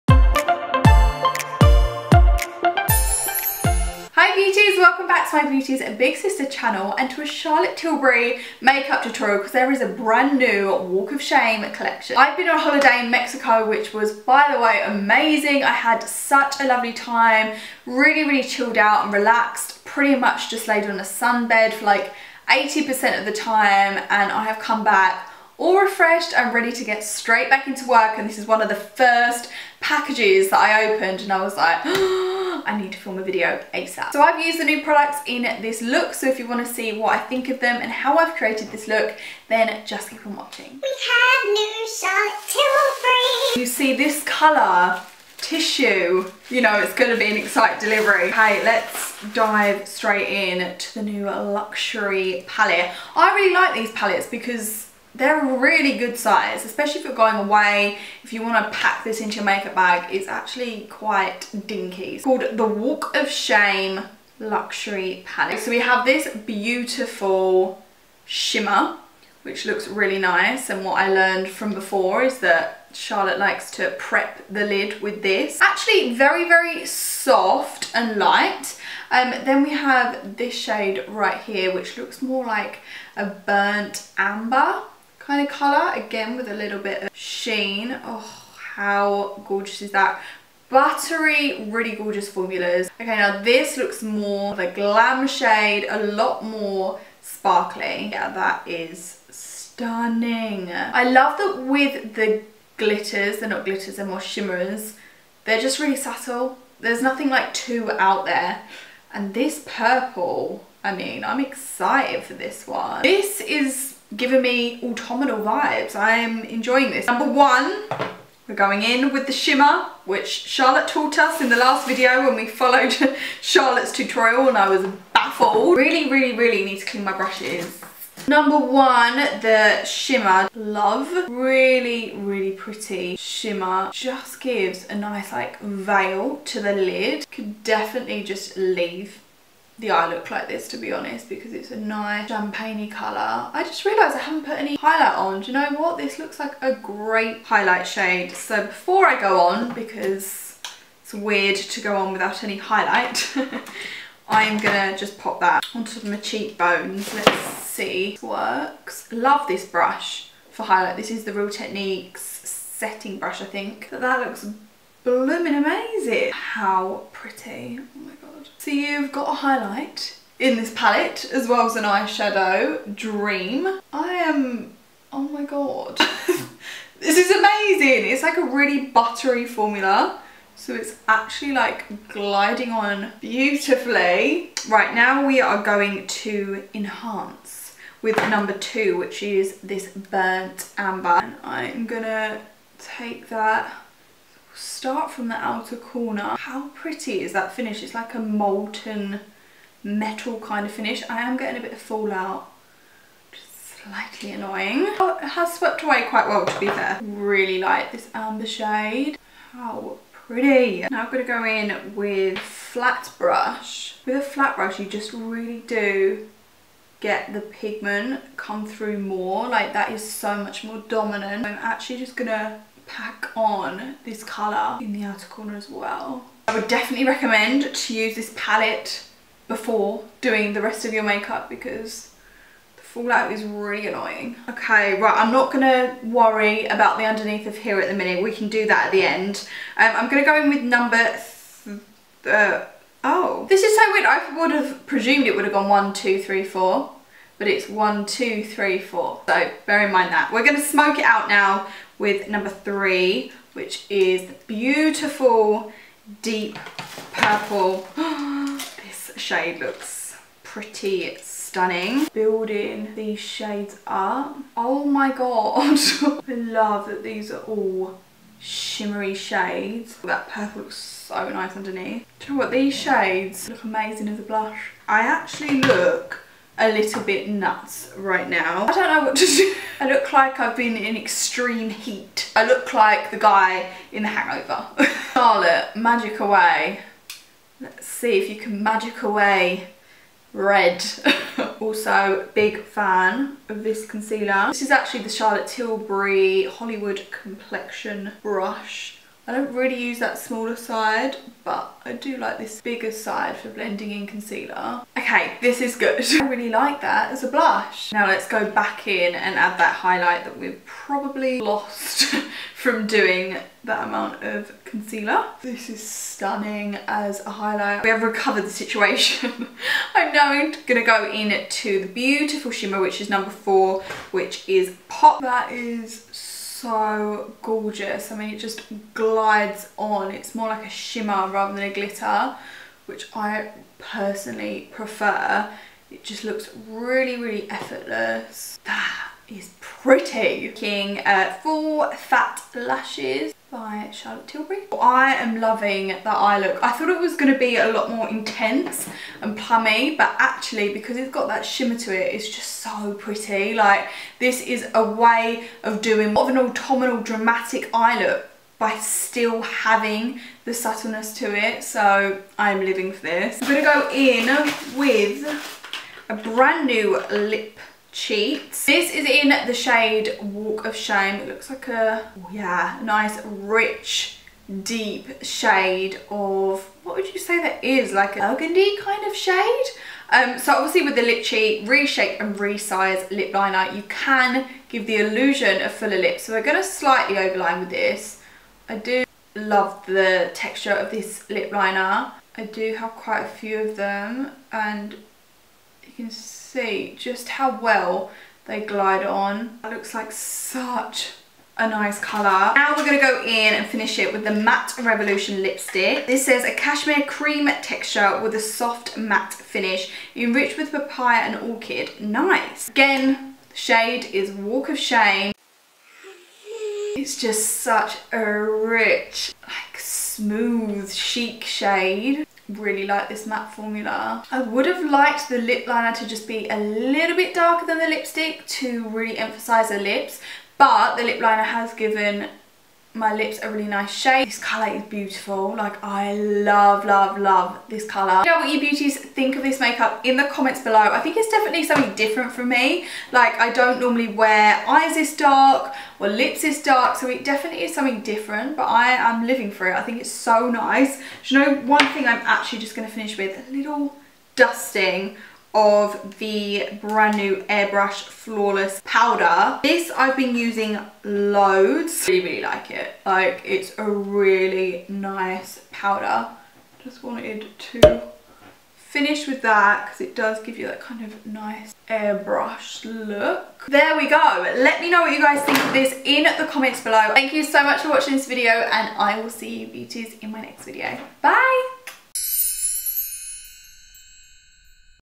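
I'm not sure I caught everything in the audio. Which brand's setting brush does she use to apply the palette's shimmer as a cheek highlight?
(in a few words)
Real Techniques.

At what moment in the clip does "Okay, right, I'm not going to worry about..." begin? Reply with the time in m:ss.
3:54.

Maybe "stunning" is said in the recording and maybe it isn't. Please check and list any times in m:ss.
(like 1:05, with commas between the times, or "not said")
1:39, 4:21, 5:15.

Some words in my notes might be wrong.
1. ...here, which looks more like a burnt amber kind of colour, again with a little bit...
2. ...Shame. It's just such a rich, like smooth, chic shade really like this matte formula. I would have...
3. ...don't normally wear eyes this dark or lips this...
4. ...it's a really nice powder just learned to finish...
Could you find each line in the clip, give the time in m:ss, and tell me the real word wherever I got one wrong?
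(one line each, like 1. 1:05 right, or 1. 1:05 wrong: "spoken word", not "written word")
1. 1:21 right
2. 6:54 right
3. 7:23 right
4. 7:43 wrong: "wanted", not "learned".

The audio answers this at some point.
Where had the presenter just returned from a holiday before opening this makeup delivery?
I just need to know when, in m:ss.
0:13.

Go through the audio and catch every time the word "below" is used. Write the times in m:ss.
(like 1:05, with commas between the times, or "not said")
7:20, 7:56.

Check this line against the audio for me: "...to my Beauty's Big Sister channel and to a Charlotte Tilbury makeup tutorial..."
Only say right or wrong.
right.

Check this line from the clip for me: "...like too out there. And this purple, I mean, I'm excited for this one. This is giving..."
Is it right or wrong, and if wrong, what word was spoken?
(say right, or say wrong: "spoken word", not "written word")
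right.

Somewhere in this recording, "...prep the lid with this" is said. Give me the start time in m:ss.
1:13.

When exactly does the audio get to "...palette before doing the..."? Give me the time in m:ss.
3:48.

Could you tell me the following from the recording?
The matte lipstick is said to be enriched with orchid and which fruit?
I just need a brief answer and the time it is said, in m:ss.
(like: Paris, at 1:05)
papaya, at 6:50.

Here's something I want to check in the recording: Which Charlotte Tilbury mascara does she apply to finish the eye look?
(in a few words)
Full Fat Lashes.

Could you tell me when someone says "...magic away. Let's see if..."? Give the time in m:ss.
4:45.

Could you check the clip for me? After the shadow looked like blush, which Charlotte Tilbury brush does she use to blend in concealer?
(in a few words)
Hollywood Complexion Brush.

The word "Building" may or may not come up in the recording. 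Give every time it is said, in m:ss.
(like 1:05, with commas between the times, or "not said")
4:22.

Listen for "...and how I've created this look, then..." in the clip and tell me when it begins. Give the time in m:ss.
0:37.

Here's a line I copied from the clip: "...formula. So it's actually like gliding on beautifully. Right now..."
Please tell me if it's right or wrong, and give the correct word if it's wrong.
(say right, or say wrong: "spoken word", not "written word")
right.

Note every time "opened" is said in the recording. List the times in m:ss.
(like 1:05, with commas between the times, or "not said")
0:30.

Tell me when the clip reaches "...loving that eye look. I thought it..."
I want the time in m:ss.
5:45.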